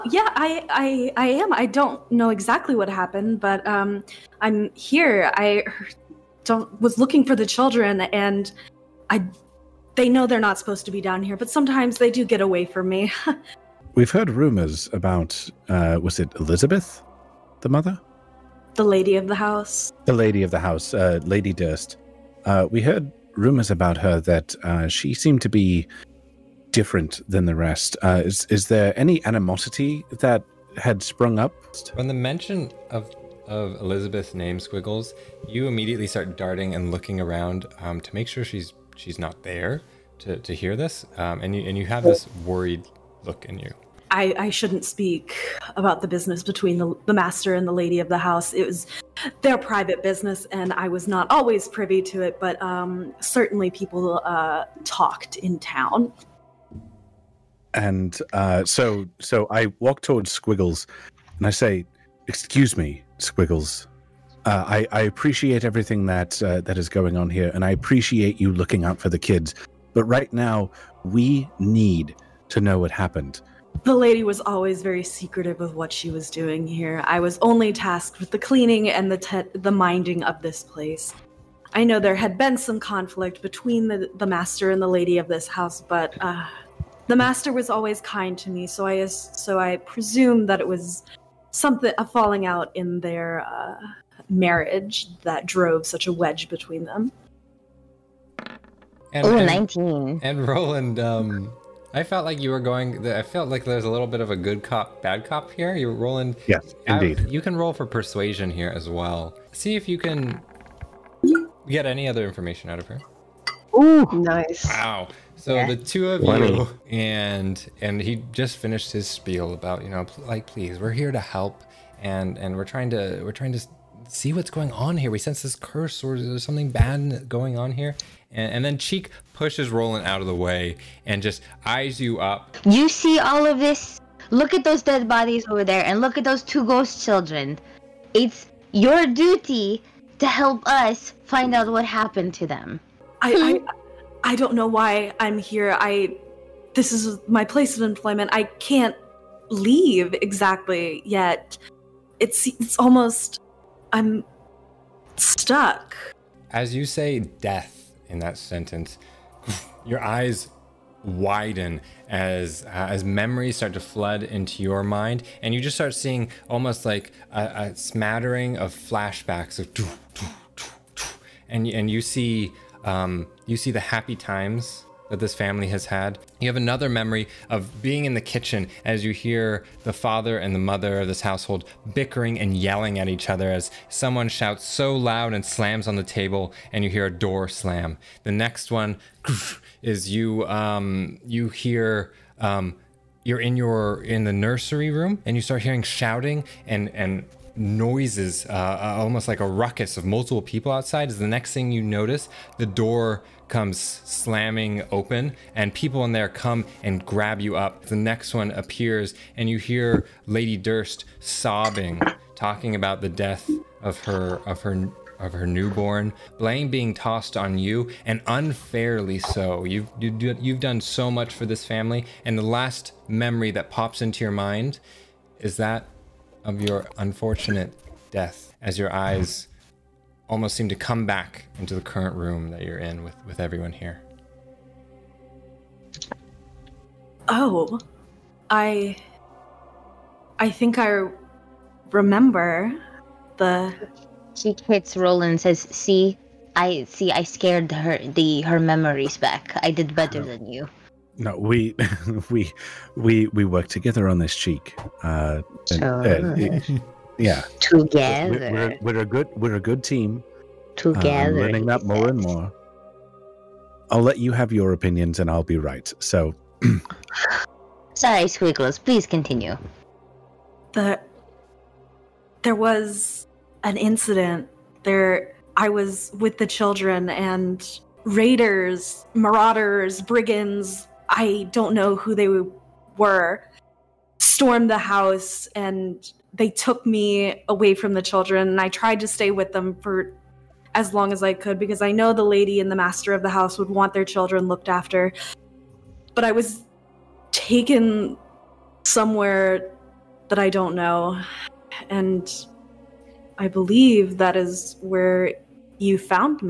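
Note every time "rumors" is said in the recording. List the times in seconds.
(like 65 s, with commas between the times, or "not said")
14 s, 23 s.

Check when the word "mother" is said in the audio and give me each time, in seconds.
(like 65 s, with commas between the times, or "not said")
17 s, 180 s.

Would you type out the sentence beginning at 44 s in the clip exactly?
I, I shouldn't speak about the business between the, the master and the lady of the house.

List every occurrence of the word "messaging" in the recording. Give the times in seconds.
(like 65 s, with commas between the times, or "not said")
not said.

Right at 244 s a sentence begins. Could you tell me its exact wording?
She hits Roland says, "See, I see.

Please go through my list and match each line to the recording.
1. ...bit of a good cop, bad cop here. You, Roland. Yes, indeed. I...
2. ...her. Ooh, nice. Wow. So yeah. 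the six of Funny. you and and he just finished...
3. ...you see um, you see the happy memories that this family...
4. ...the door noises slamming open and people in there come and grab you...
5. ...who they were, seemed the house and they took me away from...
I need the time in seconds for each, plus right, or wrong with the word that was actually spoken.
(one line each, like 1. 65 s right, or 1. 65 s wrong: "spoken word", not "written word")
1. 104 s right
2. 112 s wrong: "two", not "six"
3. 171 s wrong: "times", not "memories"
4. 202 s wrong: "comes", not "noises"
5. 281 s wrong: "stormed", not "seemed".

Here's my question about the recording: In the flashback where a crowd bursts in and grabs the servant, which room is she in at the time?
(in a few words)
The nursery.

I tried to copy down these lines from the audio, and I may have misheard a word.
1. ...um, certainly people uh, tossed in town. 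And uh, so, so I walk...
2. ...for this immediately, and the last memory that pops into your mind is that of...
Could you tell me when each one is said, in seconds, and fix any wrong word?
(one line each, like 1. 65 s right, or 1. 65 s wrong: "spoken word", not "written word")
1. 52 s wrong: "talked", not "tossed"
2. 221 s wrong: "family", not "immediately".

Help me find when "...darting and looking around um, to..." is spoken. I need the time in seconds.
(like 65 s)
36 s.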